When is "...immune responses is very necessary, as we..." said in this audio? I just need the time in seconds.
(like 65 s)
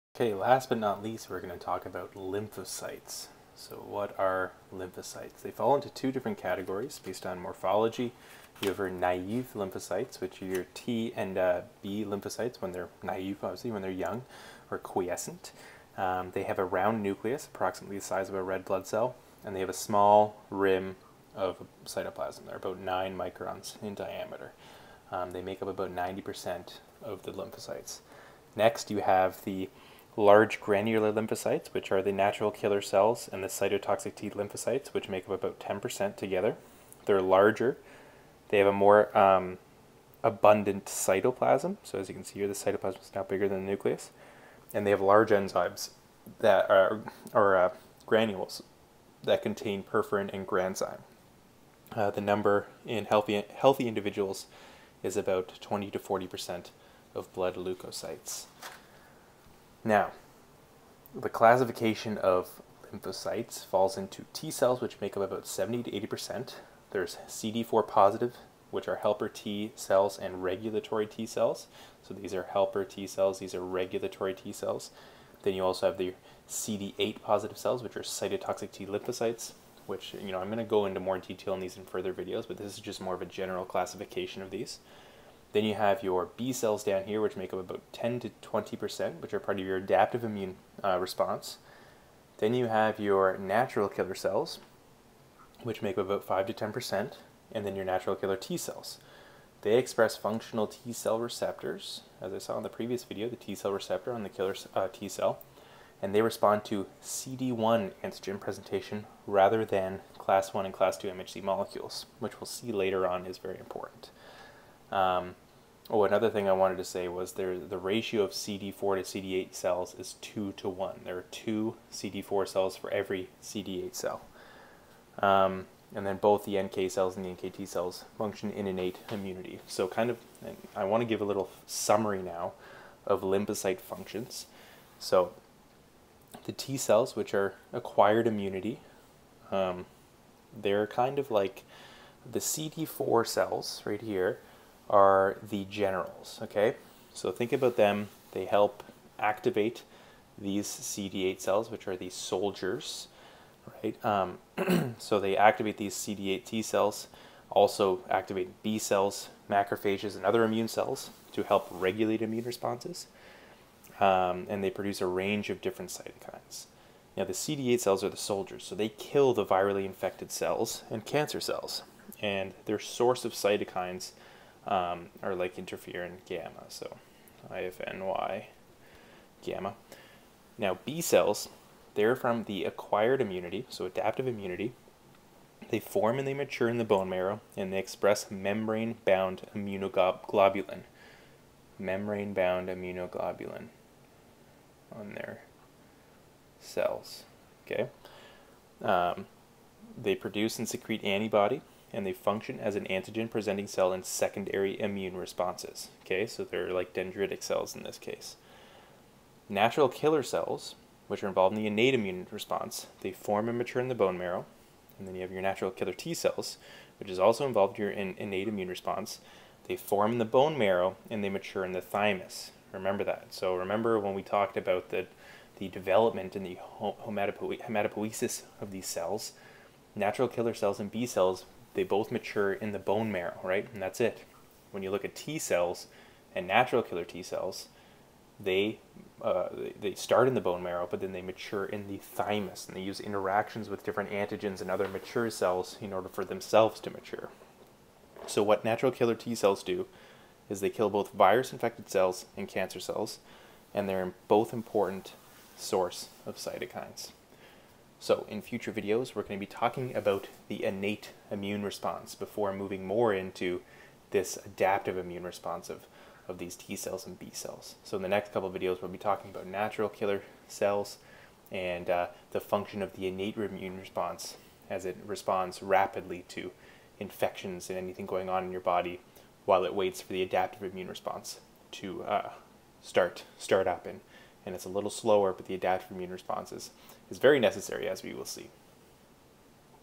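285 s.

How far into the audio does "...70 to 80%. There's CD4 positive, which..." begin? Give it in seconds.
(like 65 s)
65 s.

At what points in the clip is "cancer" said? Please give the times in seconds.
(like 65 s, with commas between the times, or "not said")
171 s, 252 s.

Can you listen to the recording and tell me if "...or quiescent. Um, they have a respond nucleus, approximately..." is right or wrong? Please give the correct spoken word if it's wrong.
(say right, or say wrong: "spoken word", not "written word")
wrong: "round", not "respond".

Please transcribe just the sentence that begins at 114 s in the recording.
Um, oh, another thing I wanted to say was there the ratio of CD4 to CD8 cells is 2 to 1.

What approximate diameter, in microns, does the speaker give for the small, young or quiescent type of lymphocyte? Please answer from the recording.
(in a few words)
9 microns.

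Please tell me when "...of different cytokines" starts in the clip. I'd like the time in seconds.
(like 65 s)
165 s.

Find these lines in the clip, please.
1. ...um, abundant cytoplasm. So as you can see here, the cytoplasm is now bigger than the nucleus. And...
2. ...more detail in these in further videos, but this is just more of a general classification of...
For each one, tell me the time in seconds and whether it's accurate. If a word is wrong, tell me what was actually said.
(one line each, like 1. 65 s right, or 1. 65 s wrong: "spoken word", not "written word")
1. 39 s right
2. 80 s right.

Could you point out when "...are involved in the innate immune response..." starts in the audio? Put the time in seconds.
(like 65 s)
211 s.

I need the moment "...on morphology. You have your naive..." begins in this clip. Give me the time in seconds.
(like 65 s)
7 s.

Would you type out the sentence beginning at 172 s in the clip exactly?
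And their source of cytokines um, or like interferon gamma.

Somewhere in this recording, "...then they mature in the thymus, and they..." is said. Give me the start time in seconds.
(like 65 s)
240 s.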